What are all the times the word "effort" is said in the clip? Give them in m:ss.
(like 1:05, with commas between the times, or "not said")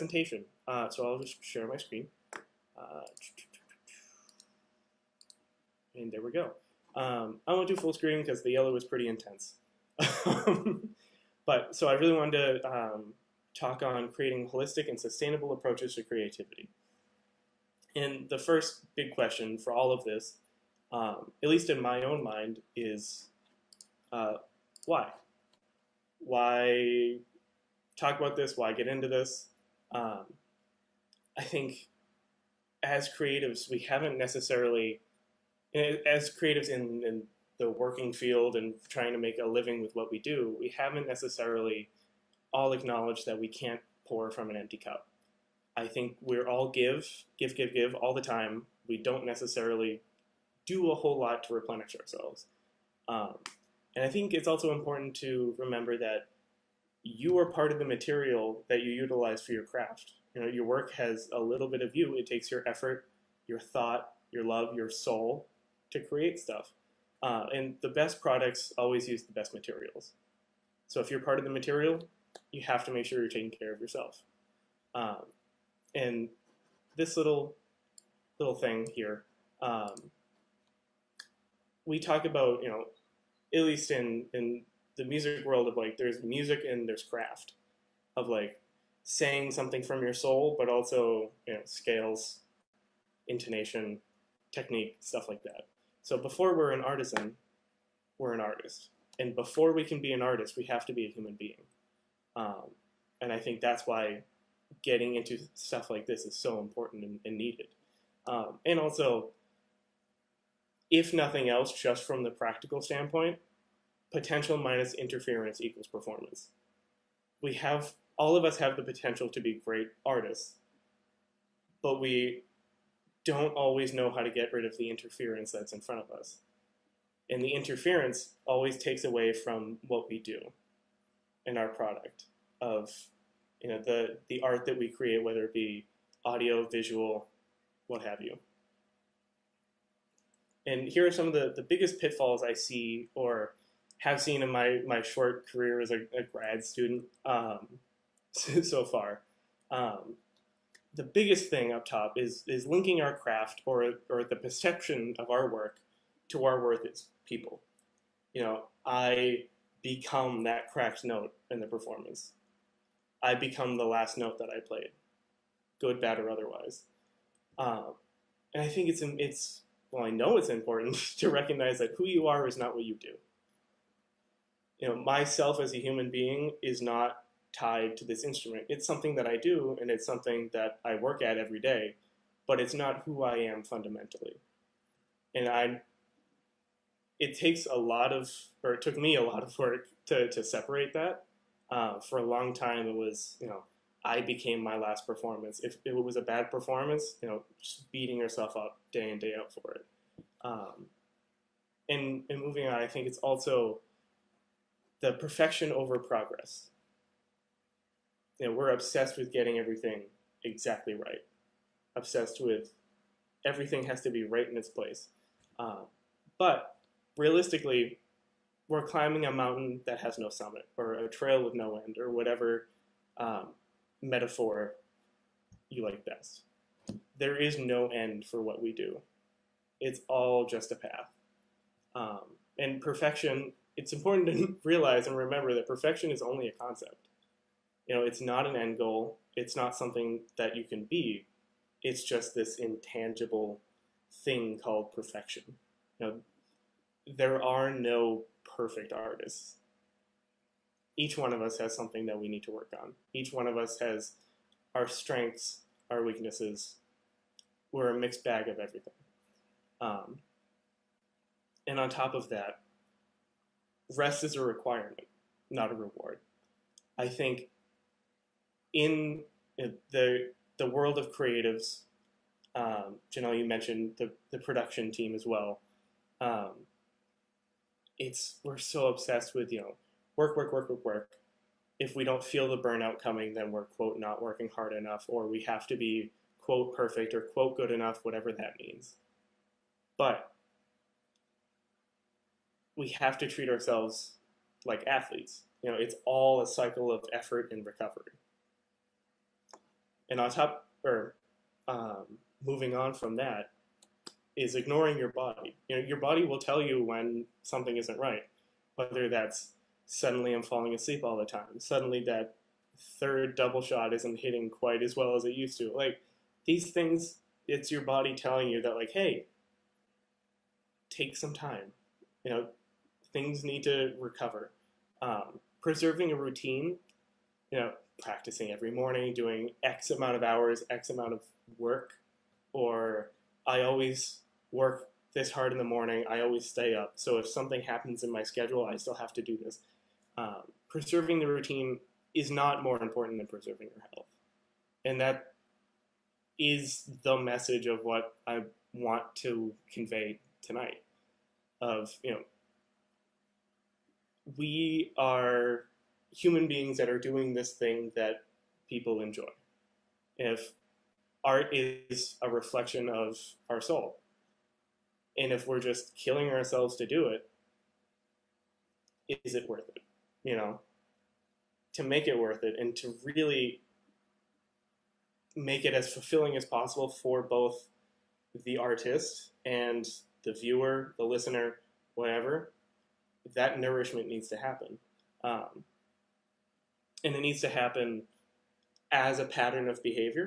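1:02, 4:57.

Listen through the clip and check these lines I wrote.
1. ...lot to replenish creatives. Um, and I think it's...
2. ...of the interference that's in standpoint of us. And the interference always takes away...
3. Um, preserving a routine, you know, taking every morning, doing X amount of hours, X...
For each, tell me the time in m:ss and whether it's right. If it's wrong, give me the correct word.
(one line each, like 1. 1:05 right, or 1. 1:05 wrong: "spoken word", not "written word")
1. 0:51 wrong: "ourselves", not "creatives"
2. 2:04 wrong: "front", not "standpoint"
3. 5:25 wrong: "practicing", not "taking".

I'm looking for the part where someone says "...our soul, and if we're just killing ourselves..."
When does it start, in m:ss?
6:03.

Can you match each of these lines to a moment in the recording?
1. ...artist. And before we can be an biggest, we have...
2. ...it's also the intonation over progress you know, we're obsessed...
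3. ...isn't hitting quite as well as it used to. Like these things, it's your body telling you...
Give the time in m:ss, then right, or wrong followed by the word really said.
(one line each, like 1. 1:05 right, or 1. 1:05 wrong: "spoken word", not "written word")
1. 1:38 wrong: "artist", not "biggest"
2. 3:23 wrong: "perfection", not "intonation"
3. 5:13 right.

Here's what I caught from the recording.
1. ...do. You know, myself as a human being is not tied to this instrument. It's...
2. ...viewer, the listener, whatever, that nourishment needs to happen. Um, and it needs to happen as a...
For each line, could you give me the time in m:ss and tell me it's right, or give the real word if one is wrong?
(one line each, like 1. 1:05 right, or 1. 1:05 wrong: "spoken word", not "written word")
1. 2:52 right
2. 6:20 right.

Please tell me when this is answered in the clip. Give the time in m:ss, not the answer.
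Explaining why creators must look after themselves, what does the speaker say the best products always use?
1:09.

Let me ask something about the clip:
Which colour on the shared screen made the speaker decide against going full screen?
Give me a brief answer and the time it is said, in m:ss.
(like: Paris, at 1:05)
Yellow, at 0:08.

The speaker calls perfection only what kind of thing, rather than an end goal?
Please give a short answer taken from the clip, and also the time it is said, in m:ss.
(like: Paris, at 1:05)
A concept, at 3:56.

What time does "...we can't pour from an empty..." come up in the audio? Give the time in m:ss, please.
0:43.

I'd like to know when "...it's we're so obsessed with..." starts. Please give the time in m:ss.
4:37.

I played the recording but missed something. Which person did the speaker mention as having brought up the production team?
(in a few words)
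Janelle.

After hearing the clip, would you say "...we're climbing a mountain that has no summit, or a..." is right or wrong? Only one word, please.
right.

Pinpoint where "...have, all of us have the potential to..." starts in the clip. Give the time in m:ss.
1:57.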